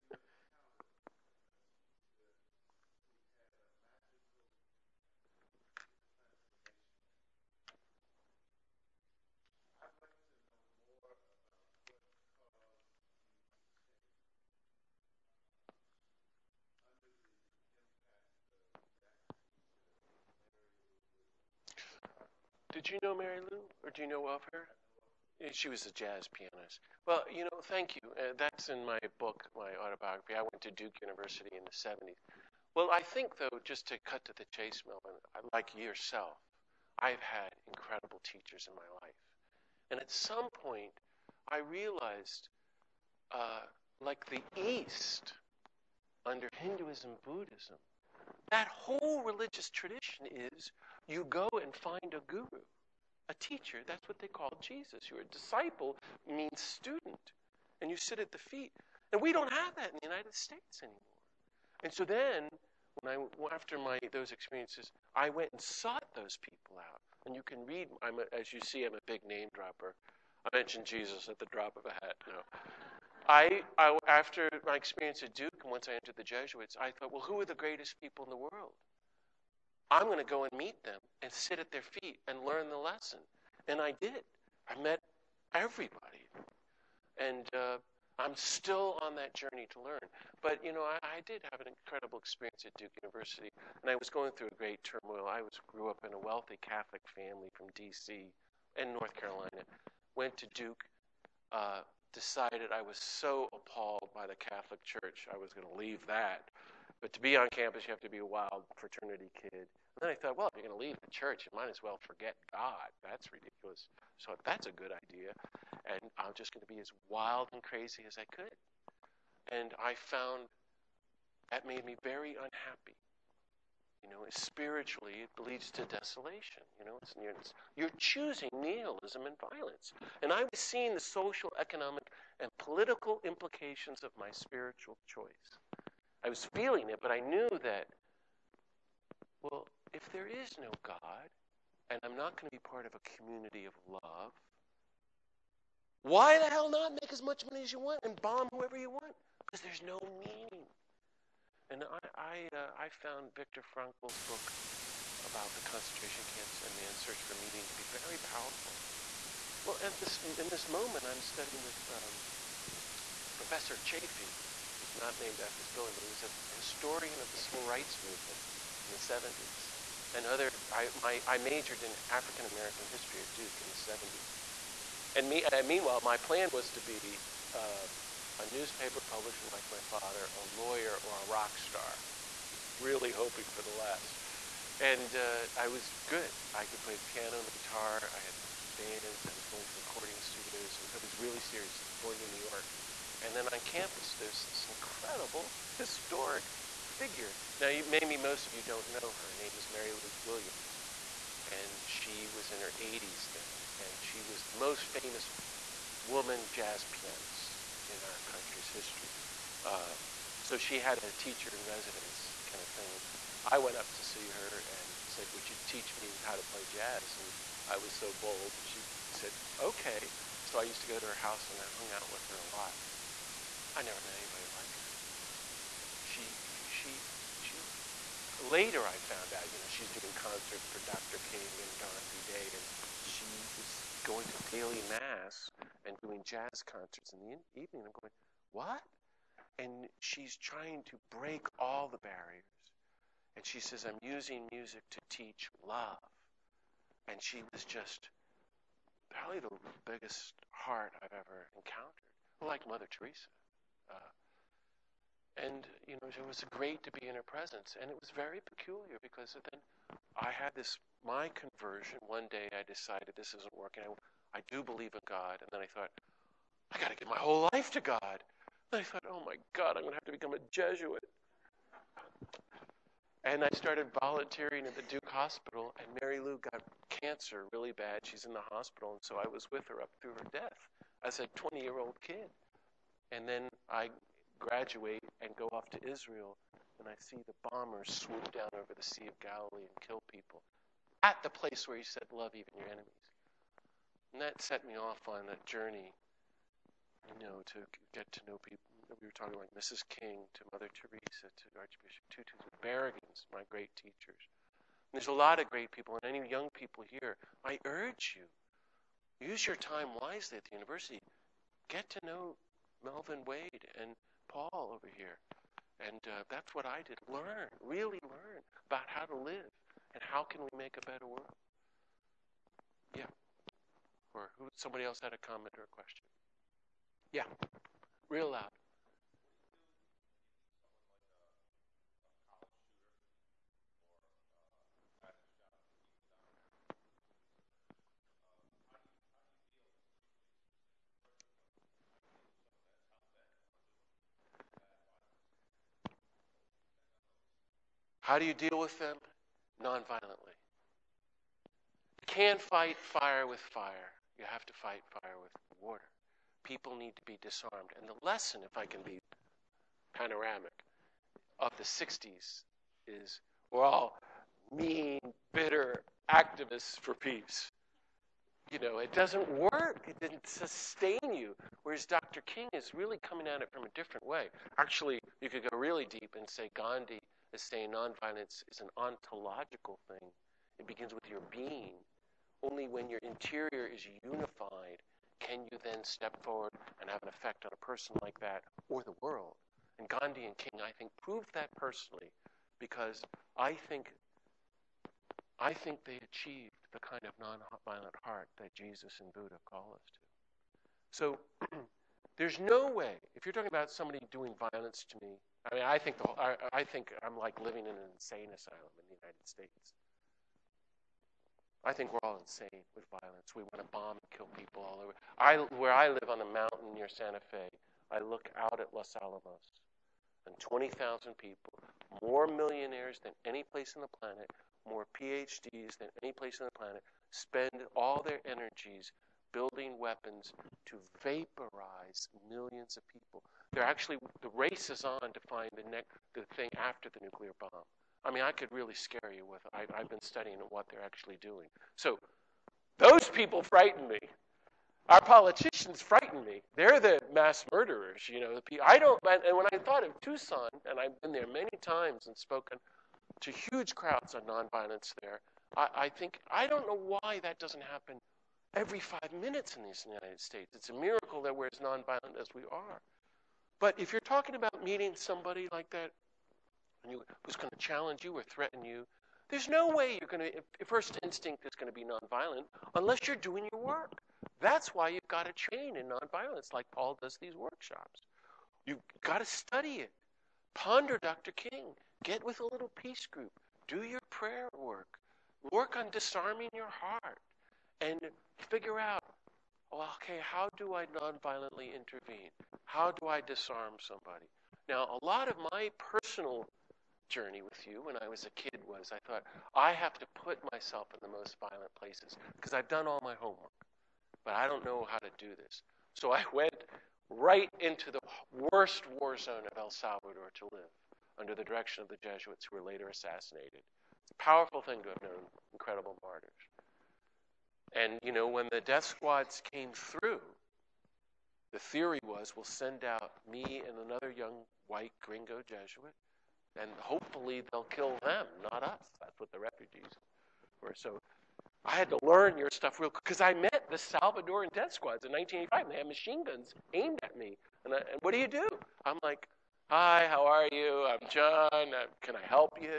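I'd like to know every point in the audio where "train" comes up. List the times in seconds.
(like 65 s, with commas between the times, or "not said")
475 s.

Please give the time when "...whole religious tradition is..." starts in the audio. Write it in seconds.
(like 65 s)
48 s.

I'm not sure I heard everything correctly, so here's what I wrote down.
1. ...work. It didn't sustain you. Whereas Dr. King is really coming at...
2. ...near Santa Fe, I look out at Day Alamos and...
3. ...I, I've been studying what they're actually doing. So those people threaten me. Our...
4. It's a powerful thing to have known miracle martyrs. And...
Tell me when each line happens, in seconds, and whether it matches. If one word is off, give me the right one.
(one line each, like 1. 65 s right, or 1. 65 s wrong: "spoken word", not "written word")
1. 369 s right
2. 416 s wrong: "Los", not "Day"
3. 439 s wrong: "frighten", not "threaten"
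4. 514 s wrong: "incredible", not "miracle".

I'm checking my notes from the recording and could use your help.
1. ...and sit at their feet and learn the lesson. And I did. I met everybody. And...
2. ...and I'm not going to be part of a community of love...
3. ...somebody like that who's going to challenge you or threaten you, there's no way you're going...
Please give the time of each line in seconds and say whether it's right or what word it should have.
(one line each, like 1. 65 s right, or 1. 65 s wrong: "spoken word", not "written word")
1. 81 s right
2. 141 s right
3. 464 s right.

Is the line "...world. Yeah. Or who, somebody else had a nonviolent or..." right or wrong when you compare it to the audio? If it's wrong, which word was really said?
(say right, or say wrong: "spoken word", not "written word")
wrong: "comment", not "nonviolent".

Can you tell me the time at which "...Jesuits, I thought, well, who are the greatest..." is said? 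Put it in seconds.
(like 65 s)
76 s.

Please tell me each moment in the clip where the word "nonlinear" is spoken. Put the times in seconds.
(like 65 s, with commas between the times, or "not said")
not said.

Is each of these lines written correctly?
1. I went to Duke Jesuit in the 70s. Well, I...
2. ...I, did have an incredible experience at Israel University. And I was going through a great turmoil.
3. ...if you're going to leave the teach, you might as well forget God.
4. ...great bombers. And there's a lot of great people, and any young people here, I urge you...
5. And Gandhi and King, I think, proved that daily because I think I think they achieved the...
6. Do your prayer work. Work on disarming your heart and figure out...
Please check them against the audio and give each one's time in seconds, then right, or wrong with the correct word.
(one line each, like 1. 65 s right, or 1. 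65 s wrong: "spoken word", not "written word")
1. 30 s wrong: "University", not "Jesuit"
2. 91 s wrong: "Duke", not "Israel"
3. 110 s wrong: "church", not "teach"
4. 303 s wrong: "teachers", not "bombers"
5. 389 s wrong: "personally", not "daily"
6. 483 s right.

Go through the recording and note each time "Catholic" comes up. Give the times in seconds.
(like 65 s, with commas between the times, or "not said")
96 s, 104 s.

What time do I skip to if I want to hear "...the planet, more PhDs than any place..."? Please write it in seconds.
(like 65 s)
423 s.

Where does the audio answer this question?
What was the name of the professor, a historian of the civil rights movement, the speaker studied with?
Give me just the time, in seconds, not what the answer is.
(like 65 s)
163 s.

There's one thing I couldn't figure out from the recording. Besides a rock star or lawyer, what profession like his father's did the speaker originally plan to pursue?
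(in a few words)
newspaper publisher.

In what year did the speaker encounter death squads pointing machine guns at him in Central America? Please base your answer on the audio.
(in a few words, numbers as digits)
1985.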